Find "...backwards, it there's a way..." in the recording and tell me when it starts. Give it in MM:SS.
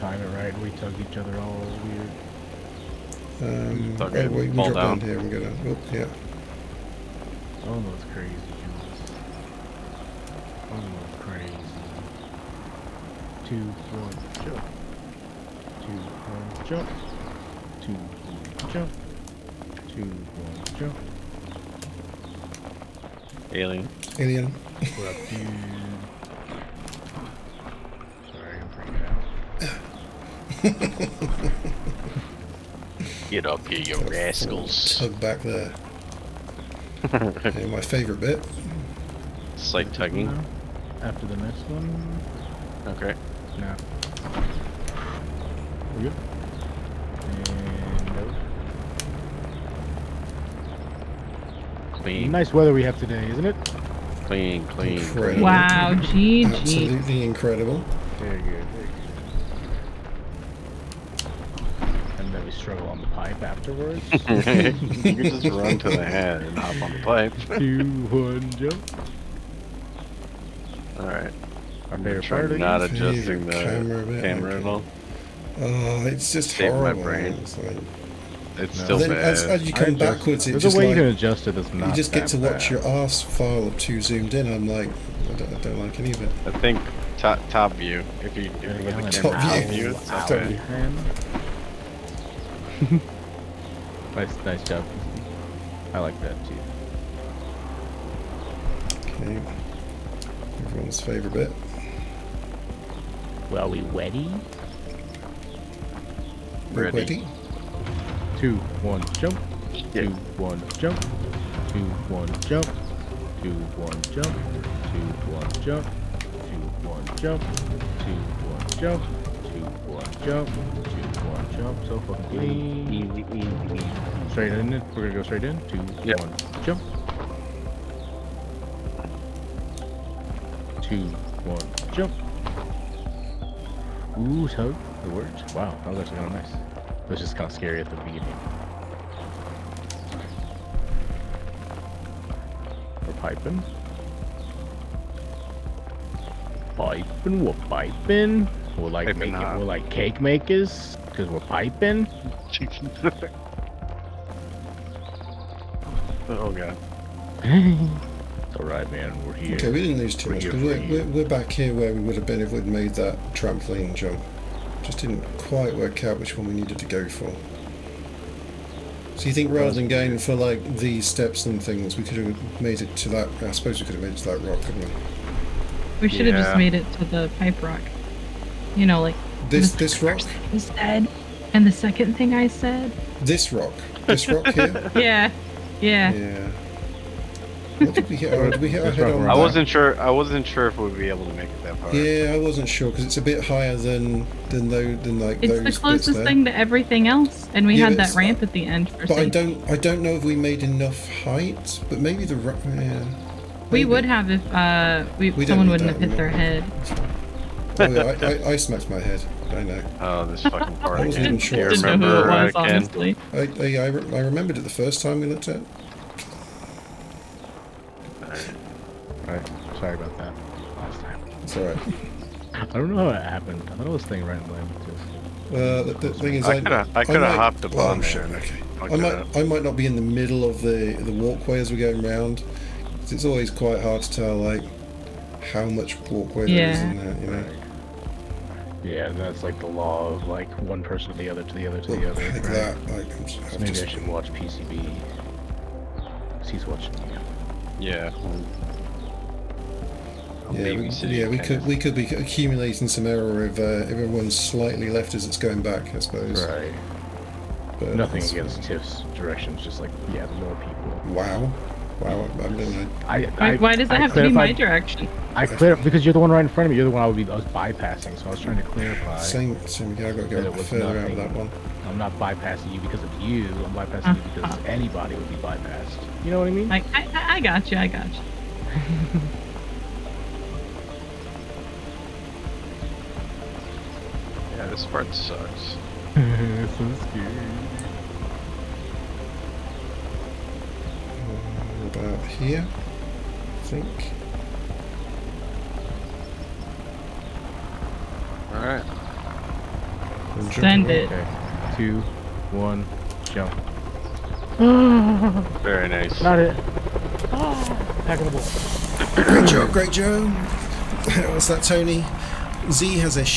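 01:20.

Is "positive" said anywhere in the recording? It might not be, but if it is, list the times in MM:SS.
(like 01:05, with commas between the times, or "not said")
not said.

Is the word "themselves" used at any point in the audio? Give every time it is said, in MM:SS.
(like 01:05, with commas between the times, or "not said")
not said.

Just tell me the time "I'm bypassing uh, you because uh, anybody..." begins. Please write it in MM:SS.
04:33.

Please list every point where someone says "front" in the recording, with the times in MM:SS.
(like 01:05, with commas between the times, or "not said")
04:26.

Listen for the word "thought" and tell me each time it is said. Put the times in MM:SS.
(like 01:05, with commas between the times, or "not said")
03:43.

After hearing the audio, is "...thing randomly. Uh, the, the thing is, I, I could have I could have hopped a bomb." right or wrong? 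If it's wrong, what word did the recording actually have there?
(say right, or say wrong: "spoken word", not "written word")
right.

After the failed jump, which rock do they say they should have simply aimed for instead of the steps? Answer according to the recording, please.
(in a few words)
the pipe rock.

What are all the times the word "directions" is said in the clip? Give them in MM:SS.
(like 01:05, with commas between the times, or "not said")
04:19, 04:24.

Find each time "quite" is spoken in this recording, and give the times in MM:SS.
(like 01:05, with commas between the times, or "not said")
02:45, 03:53.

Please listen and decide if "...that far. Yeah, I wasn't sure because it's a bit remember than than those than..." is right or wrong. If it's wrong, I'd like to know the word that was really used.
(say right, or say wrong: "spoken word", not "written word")
wrong: "higher", not "remember".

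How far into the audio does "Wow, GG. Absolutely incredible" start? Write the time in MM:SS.
00:55.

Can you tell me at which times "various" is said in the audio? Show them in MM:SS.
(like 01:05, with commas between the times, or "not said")
not said.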